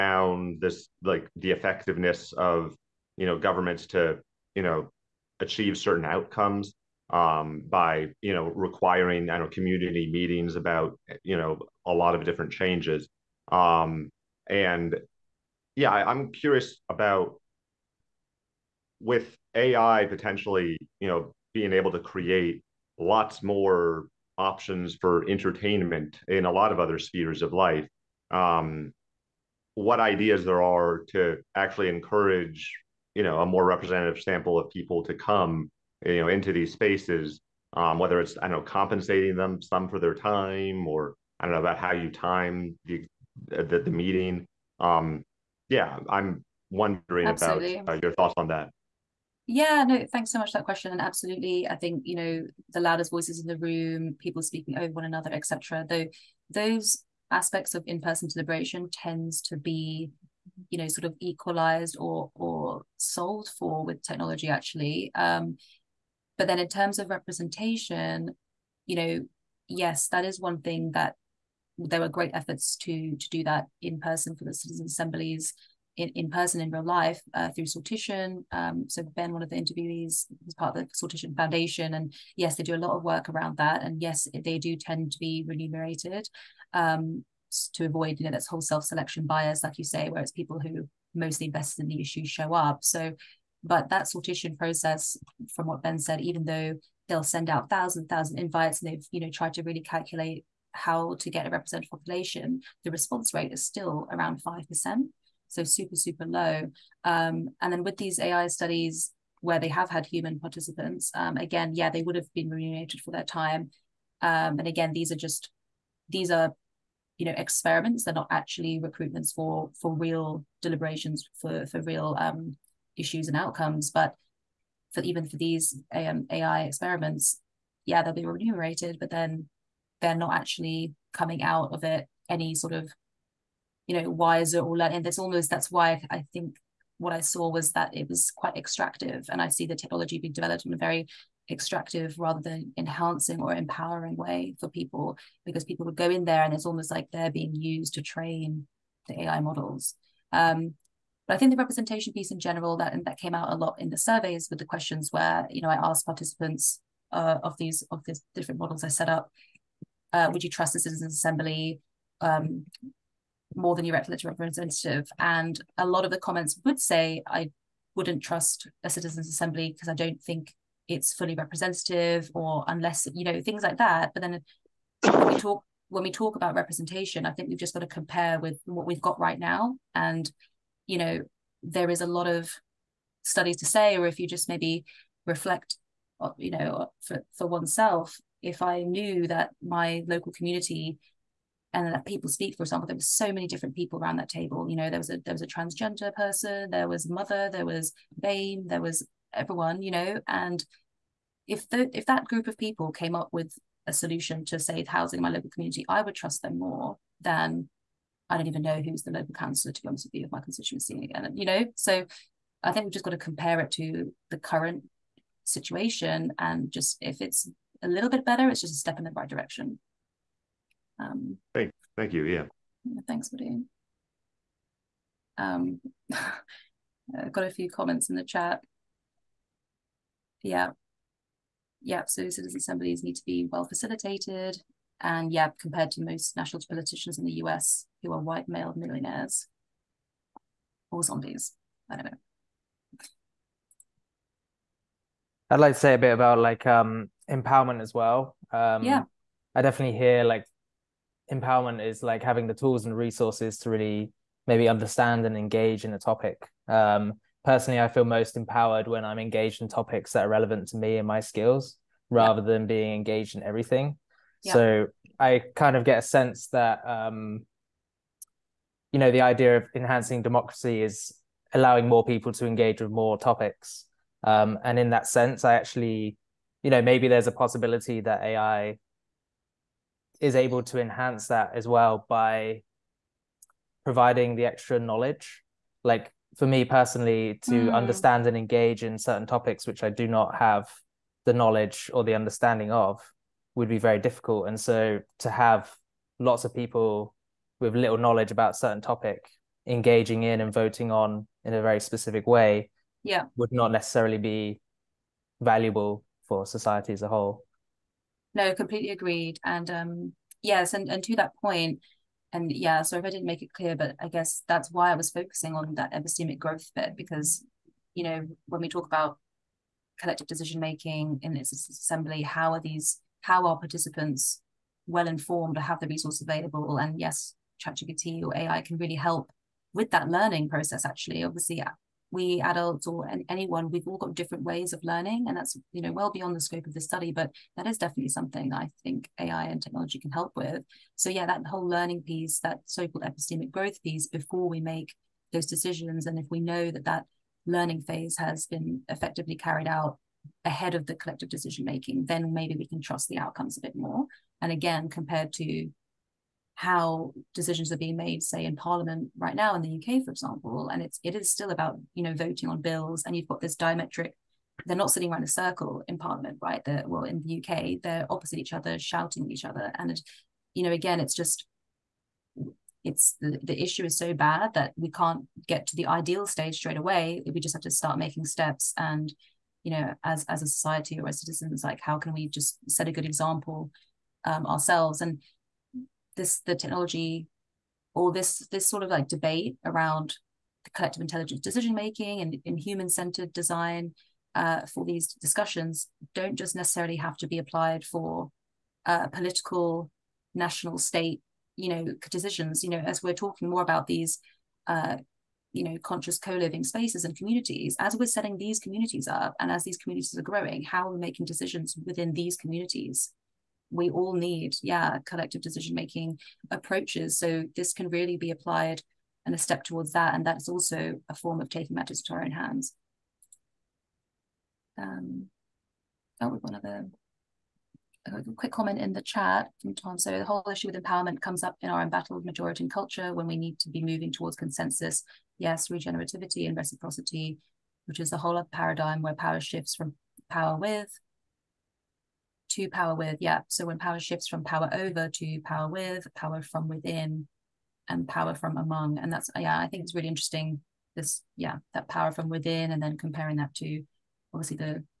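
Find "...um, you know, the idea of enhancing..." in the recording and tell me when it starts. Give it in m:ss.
4:26.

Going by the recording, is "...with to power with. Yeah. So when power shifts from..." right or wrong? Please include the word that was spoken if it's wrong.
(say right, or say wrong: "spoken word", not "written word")
right.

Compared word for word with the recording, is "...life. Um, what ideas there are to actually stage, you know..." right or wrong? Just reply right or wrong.
wrong.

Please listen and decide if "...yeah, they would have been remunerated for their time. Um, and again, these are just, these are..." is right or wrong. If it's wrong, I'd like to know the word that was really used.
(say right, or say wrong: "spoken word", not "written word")
right.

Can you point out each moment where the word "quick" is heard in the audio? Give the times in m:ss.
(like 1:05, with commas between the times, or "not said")
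7:08.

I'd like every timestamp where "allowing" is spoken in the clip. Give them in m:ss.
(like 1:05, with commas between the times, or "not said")
4:31.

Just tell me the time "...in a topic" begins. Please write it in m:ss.
4:15.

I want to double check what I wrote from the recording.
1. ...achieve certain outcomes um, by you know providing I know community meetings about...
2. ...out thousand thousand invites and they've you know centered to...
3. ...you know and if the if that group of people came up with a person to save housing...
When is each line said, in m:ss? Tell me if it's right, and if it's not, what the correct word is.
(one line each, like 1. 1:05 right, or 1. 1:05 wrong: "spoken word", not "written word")
1. 0:05 wrong: "requiring", not "providing"
2. 1:37 wrong: "tried", not "centered"
3. 3:19 wrong: "solution", not "person".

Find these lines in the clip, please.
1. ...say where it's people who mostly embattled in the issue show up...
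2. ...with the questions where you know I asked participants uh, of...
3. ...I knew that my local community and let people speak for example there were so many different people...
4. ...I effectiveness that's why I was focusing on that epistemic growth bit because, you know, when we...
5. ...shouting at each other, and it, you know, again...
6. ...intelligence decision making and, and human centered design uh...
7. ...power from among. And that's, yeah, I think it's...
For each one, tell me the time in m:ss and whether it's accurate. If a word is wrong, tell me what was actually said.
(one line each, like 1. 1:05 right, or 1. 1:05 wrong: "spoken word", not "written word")
1. 1:29 wrong: "invested", not "embattled"
2. 2:34 right
3. 3:08 right
4. 5:13 wrong: "guess", not "effectiveness"
5. 6:08 right
6. 6:31 right
7. 7:28 right.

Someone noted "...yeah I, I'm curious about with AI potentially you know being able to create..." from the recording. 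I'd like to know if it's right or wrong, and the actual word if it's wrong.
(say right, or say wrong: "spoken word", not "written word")
right.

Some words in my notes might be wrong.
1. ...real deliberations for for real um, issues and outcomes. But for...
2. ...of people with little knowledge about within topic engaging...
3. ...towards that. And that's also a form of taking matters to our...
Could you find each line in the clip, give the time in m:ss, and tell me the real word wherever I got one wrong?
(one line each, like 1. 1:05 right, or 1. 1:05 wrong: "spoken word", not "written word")
1. 1:59 right
2. 4:56 wrong: "certain", not "within"
3. 6:59 right.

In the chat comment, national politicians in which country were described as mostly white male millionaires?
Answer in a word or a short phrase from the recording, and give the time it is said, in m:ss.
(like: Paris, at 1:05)
US, at 3:57.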